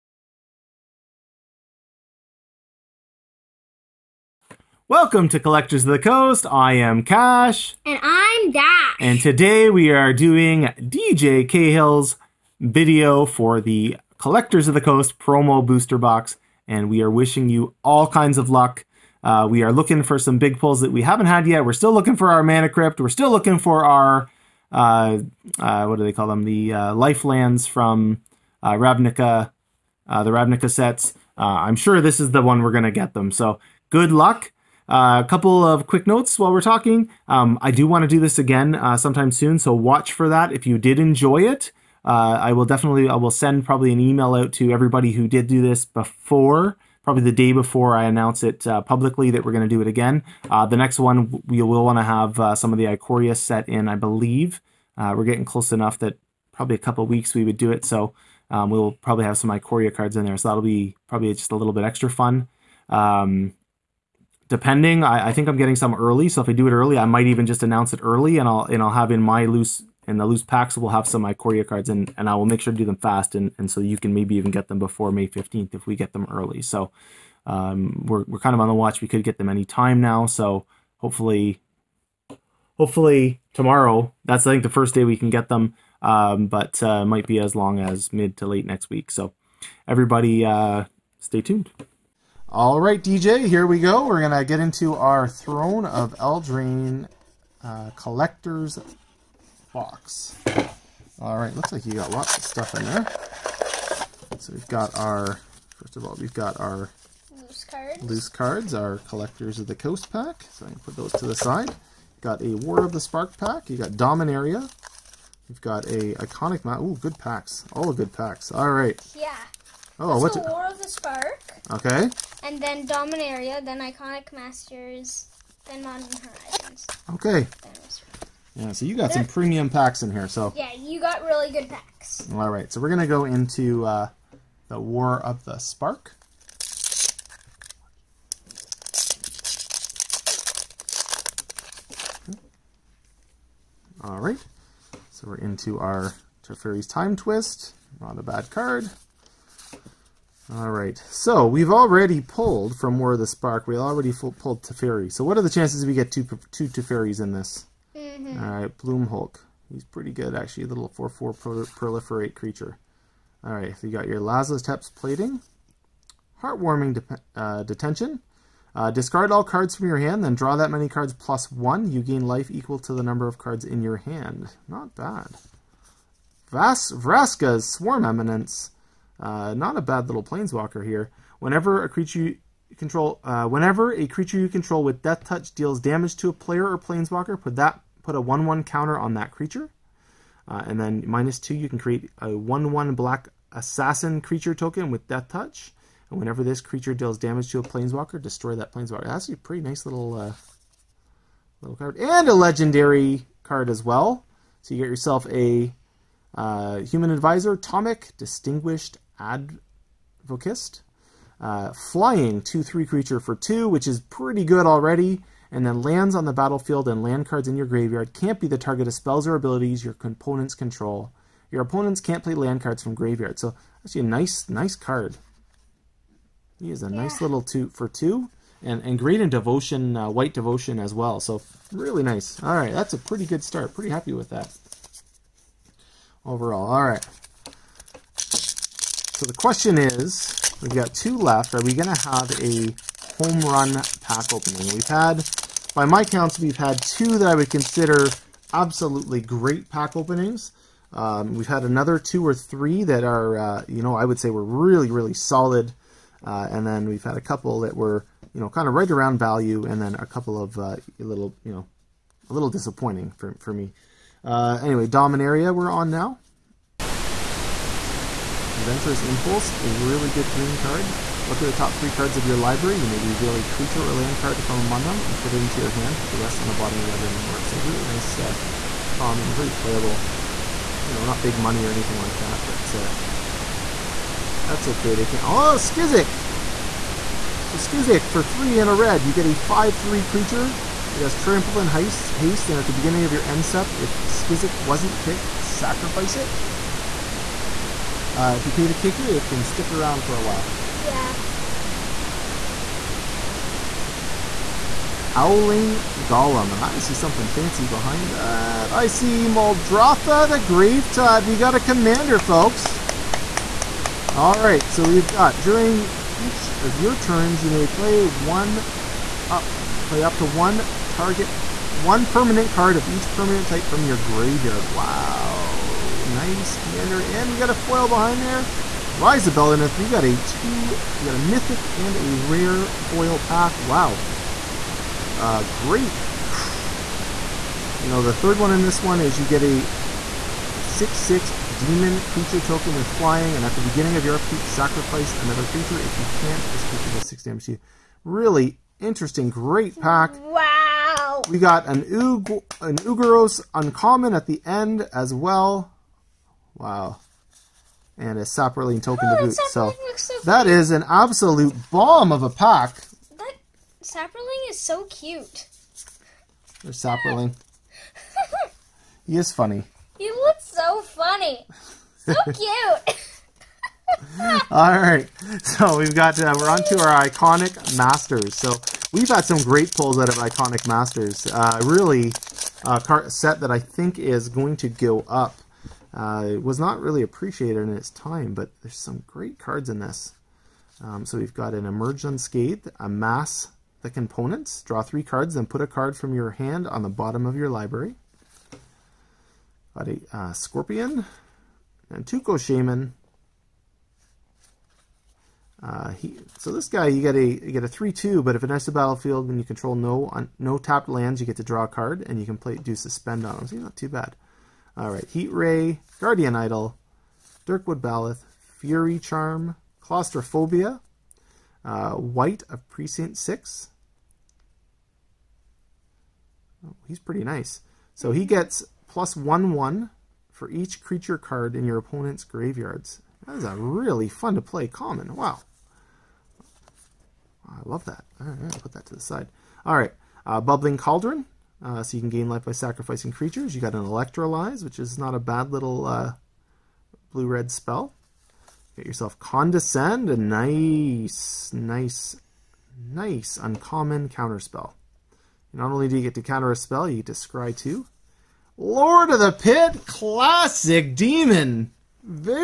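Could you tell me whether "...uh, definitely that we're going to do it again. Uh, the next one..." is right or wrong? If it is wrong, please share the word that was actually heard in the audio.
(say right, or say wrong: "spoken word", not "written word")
wrong: "publicly", not "definitely".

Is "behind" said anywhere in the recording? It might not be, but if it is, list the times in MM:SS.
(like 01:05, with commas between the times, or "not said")
05:07, 05:27.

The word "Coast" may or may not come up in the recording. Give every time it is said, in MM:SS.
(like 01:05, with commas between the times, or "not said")
00:05, 00:14, 01:49.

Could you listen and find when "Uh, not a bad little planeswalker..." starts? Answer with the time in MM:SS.
02:59.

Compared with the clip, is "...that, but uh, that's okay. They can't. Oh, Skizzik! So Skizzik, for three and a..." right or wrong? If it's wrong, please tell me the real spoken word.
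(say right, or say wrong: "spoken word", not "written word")
right.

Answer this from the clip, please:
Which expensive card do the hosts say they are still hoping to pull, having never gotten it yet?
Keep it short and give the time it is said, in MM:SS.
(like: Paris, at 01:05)
Mana Crypt, at 00:22.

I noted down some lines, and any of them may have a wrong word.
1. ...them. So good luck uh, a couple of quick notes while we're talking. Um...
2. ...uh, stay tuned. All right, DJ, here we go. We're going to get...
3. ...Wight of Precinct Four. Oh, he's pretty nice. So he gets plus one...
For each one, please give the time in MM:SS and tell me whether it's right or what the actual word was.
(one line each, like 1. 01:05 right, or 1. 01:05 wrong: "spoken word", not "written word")
1. 00:33 right
2. 01:30 right
3. 07:01 wrong: "Six", not "Four".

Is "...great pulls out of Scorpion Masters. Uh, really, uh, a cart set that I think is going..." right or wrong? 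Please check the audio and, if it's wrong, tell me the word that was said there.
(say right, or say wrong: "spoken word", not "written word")
wrong: "Iconic", not "Scorpion".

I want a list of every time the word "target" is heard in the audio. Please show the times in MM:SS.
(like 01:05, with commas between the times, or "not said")
03:38, 05:20.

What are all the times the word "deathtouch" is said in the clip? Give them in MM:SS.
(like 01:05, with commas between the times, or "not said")
03:05, 03:15.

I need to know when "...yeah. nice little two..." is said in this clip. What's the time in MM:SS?
03:46.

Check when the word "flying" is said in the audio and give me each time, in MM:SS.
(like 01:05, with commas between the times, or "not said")
03:31, 05:42.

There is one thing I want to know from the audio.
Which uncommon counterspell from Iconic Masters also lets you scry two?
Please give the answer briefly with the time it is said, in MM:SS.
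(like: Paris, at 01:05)
Condescend, at 07:29.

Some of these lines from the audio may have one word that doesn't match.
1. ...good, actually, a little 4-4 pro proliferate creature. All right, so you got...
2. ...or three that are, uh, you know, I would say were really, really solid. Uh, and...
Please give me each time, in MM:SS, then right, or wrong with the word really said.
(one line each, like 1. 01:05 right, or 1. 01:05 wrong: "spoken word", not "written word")
1. 02:40 right
2. 04:12 right.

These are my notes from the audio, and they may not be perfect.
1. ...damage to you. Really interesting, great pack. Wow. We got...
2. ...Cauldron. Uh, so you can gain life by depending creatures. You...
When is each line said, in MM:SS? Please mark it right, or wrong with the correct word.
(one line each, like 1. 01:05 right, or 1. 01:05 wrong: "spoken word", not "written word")
1. 05:47 right
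2. 07:20 wrong: "sacrificing", not "depending".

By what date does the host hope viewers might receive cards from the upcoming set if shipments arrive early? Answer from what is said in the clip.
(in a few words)
May 15th.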